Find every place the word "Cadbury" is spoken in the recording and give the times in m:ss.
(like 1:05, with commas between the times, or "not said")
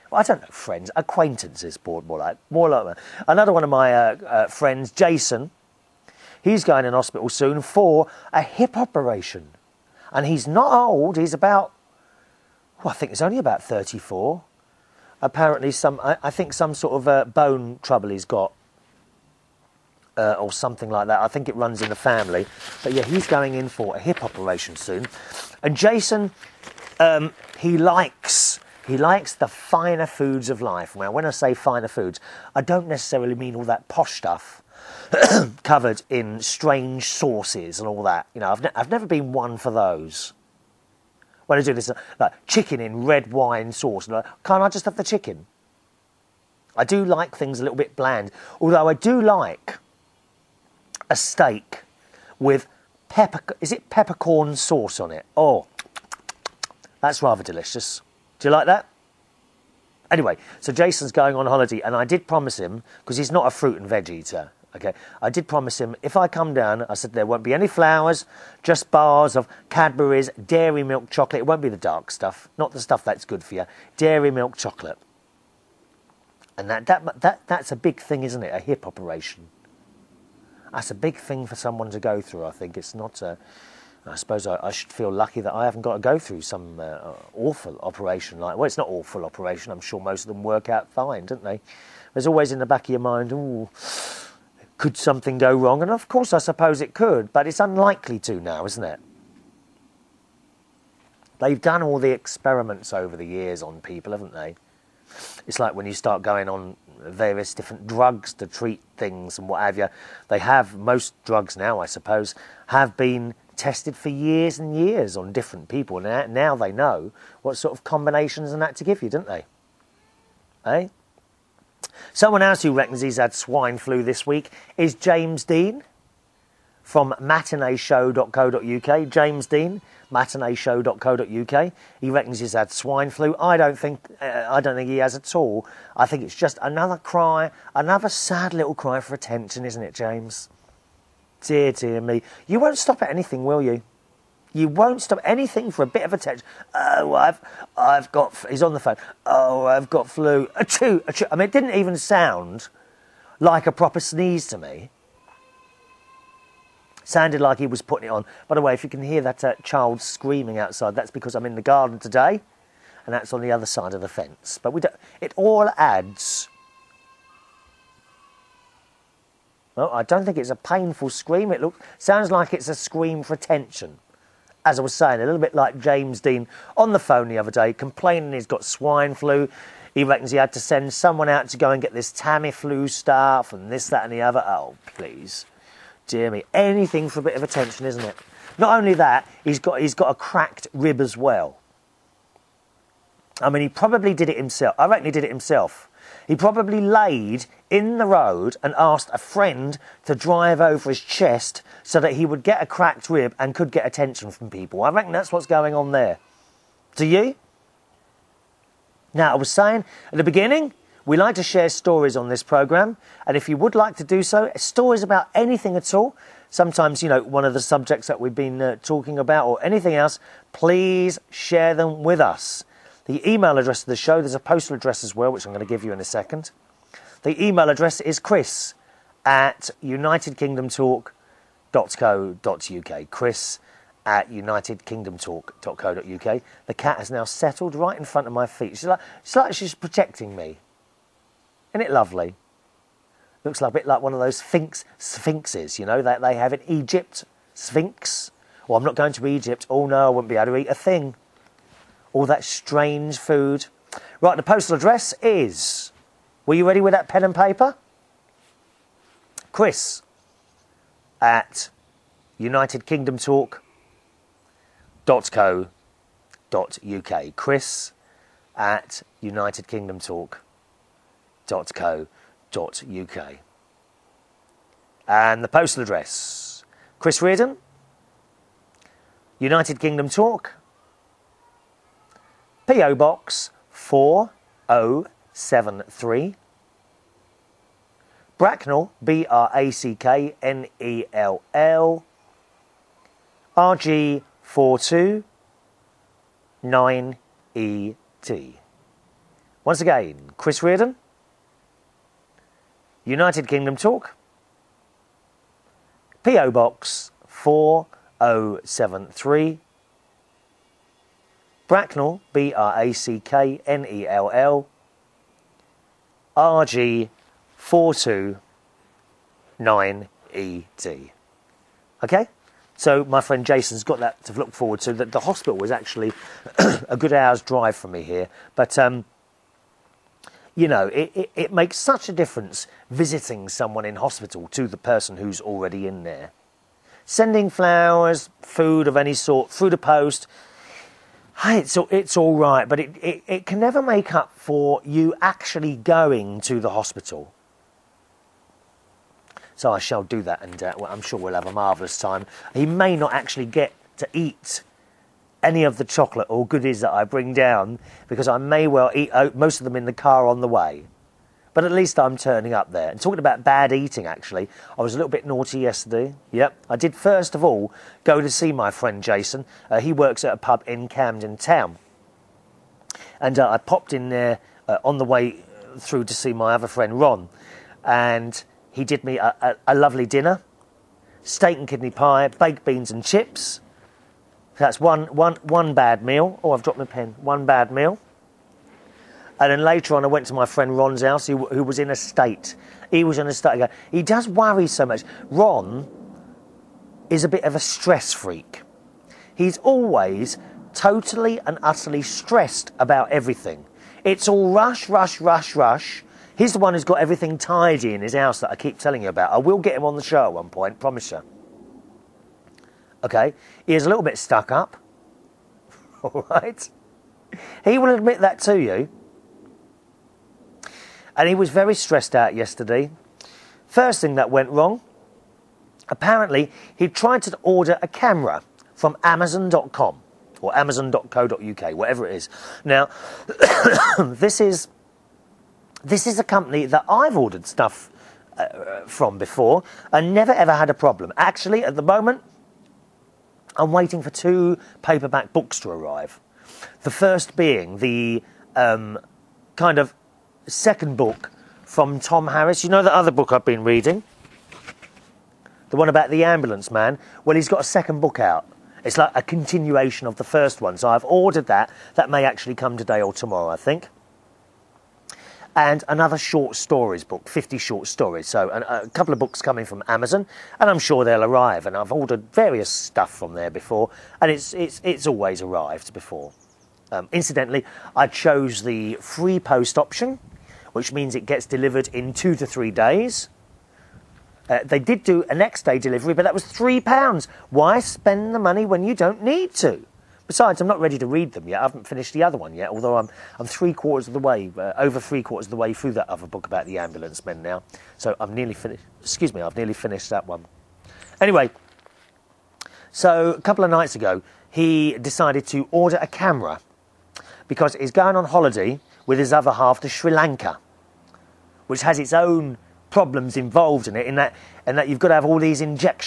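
1:09.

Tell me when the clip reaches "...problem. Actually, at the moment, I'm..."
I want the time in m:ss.
7:20.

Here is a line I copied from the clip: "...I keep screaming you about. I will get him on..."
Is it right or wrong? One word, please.
wrong.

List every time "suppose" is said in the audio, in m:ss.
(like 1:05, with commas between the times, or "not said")
1:24, 1:36, 1:51.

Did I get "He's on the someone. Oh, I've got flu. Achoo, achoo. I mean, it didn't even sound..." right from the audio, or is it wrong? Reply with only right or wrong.
wrong.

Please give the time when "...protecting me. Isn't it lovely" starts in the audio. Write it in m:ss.
3:59.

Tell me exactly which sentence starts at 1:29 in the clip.
I'm sure most of them work out fine, don't they?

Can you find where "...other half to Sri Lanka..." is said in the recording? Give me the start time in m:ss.
8:29.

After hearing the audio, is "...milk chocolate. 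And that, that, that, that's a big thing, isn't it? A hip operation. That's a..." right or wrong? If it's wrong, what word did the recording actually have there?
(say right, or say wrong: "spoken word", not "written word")
right.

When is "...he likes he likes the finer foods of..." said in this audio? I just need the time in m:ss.
0:27.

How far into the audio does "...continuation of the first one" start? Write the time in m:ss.
7:39.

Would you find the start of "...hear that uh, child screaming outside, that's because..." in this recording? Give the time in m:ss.
2:39.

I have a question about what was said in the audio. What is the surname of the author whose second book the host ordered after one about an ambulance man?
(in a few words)
Harris.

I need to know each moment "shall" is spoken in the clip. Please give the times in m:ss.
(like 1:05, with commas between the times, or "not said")
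5:49.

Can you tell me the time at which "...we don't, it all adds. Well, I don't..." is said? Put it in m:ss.
2:44.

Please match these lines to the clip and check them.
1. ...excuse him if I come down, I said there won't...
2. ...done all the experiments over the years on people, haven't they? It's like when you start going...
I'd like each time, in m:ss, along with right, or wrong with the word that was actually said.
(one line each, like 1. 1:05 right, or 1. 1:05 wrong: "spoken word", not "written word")
1. 1:05 wrong: "promise", not "excuse"
2. 1:41 right.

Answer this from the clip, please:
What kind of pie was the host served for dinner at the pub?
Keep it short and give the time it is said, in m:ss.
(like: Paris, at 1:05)
Steak and kidney, at 6:21.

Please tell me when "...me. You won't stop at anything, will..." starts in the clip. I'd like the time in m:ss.
2:22.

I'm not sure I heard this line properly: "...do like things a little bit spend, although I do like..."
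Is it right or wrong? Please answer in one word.
wrong.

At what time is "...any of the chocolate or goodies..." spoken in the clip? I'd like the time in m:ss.
5:55.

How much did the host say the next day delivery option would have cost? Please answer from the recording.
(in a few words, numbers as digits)
3 pounds.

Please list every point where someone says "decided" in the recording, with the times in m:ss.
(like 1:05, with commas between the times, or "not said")
8:24.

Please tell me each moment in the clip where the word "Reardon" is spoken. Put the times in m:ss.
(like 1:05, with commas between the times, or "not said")
4:37, 5:00.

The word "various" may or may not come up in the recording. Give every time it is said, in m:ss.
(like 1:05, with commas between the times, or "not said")
1:46, 7:52.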